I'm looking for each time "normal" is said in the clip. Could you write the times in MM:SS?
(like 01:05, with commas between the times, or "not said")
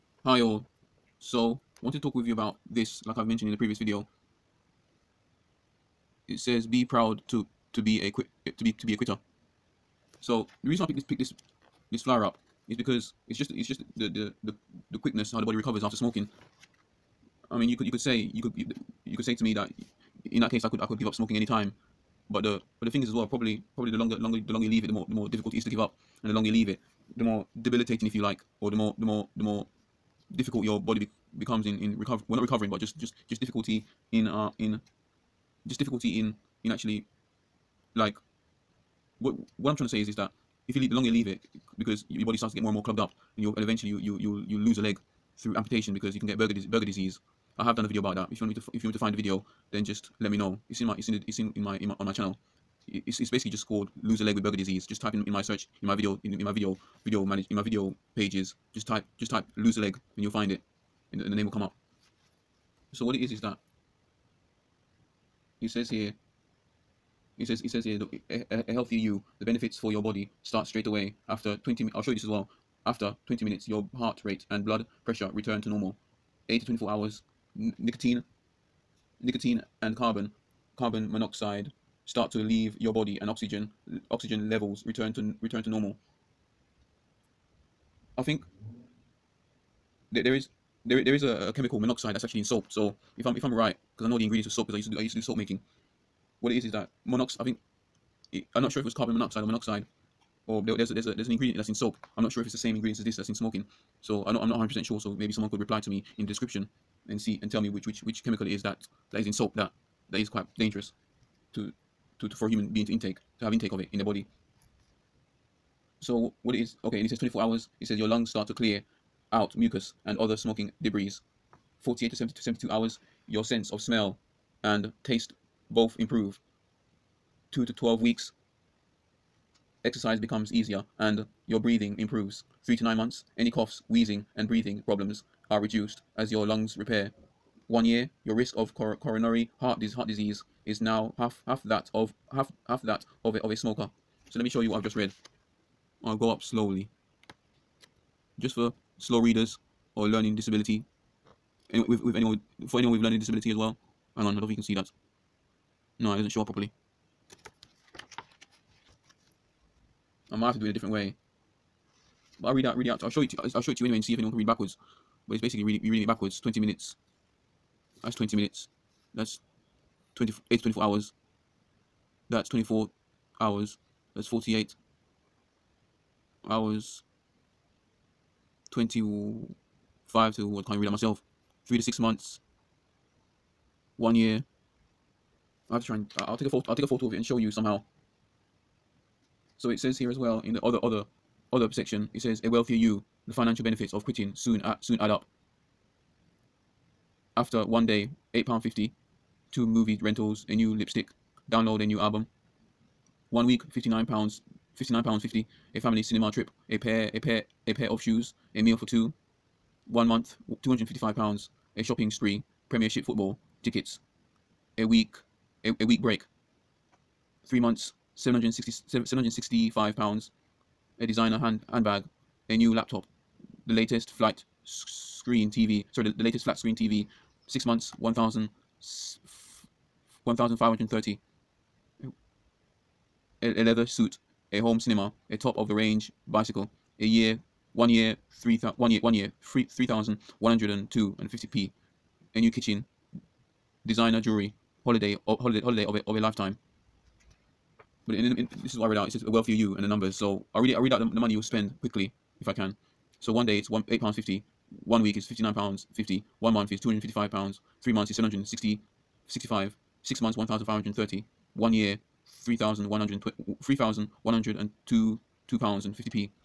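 01:15, 01:25.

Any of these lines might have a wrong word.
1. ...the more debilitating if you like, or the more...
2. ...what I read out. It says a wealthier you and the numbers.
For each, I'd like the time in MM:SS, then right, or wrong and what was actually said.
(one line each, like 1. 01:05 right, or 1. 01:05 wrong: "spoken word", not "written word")
1. 00:27 right
2. 04:08 right.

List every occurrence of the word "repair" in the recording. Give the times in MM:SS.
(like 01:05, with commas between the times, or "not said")
02:16.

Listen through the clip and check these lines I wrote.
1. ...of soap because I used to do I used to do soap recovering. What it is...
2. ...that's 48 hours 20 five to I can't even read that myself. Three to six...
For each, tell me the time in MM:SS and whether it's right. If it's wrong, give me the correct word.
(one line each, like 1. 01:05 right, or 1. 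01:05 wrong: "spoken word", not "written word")
1. 01:34 wrong: "making", not "recovering"
2. 02:54 right.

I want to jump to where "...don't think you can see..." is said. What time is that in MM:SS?
02:34.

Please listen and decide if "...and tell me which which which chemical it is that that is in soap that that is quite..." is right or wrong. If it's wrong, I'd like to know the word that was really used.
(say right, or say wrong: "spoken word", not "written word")
right.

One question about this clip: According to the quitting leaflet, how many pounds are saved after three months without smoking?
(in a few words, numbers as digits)
765 pounds.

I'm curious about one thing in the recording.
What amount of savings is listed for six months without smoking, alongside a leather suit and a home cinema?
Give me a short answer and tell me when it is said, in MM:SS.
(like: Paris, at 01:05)
1,530, at 03:50.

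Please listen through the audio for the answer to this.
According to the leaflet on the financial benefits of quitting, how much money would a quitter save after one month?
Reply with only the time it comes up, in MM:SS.
03:30.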